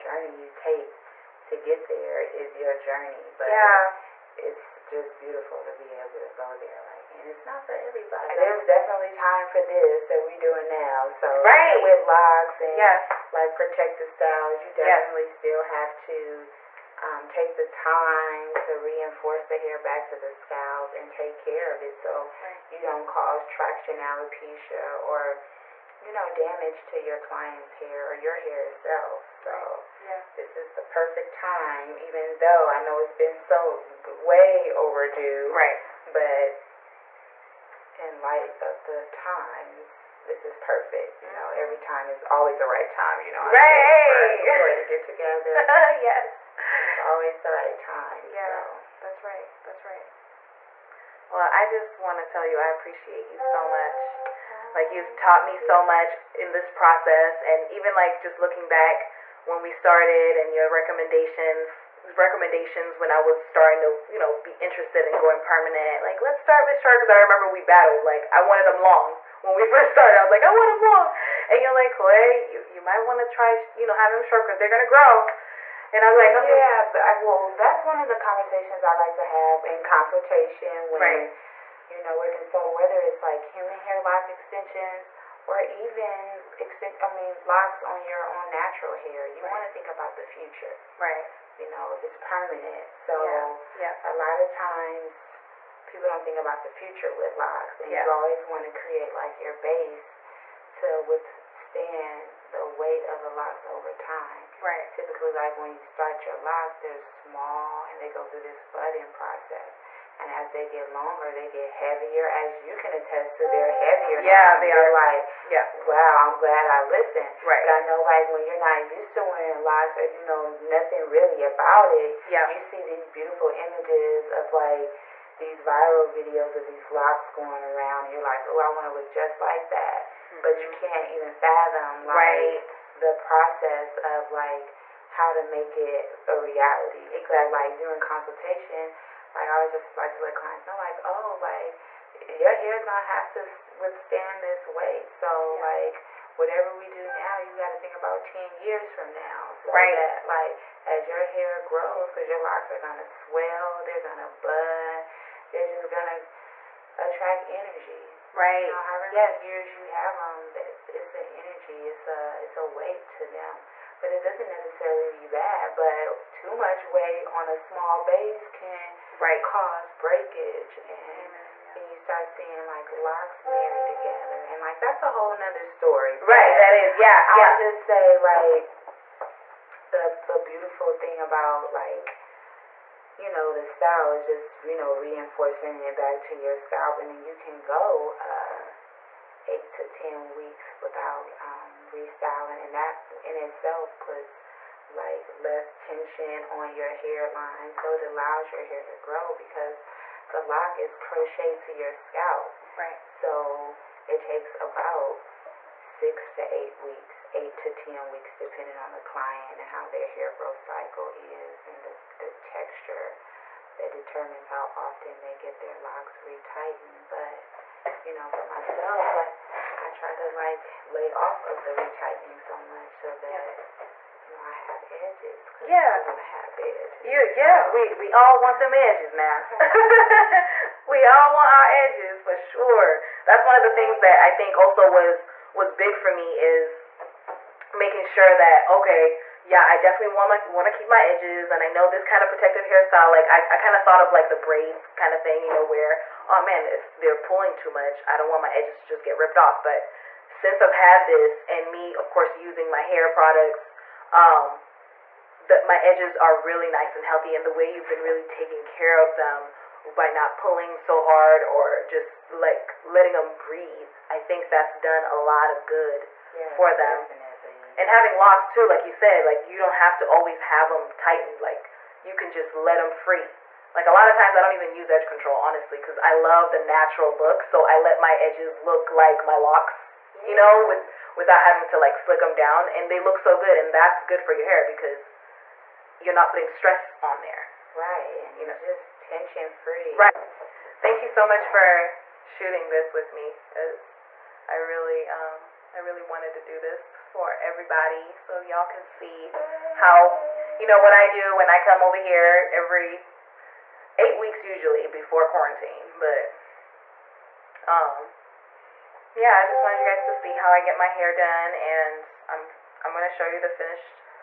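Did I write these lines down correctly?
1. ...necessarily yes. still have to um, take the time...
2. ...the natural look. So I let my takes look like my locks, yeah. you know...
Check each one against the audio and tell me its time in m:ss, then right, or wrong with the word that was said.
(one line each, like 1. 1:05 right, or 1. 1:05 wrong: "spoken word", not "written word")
1. 0:14 wrong: "definitely", not "necessarily"
2. 4:36 wrong: "edges", not "takes".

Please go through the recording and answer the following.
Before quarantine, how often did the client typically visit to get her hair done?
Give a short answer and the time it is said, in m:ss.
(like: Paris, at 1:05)
Every 8 weeks, at 5:02.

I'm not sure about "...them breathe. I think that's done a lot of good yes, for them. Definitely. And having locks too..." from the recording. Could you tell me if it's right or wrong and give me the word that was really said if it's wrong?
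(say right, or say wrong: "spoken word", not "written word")
right.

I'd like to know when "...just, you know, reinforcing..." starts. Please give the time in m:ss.
3:04.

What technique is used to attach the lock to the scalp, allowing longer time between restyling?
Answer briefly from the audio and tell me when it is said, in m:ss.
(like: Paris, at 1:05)
Crocheted, at 3:20.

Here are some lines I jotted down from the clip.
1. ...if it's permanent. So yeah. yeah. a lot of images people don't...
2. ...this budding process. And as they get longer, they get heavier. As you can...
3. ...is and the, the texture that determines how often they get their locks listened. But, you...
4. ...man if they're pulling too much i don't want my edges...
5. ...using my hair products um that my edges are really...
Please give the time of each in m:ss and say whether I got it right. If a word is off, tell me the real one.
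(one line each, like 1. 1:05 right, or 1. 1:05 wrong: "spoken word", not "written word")
1. 1:31 wrong: "times", not "images"
2. 1:48 right
3. 3:31 wrong: "retightened", not "listened"
4. 4:06 right
5. 4:12 right.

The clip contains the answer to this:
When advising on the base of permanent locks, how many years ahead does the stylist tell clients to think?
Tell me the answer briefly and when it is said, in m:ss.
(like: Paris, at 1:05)
10 years, at 2:28.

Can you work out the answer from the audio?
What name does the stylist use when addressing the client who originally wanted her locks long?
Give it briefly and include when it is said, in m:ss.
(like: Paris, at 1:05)
Koi, at 1:11.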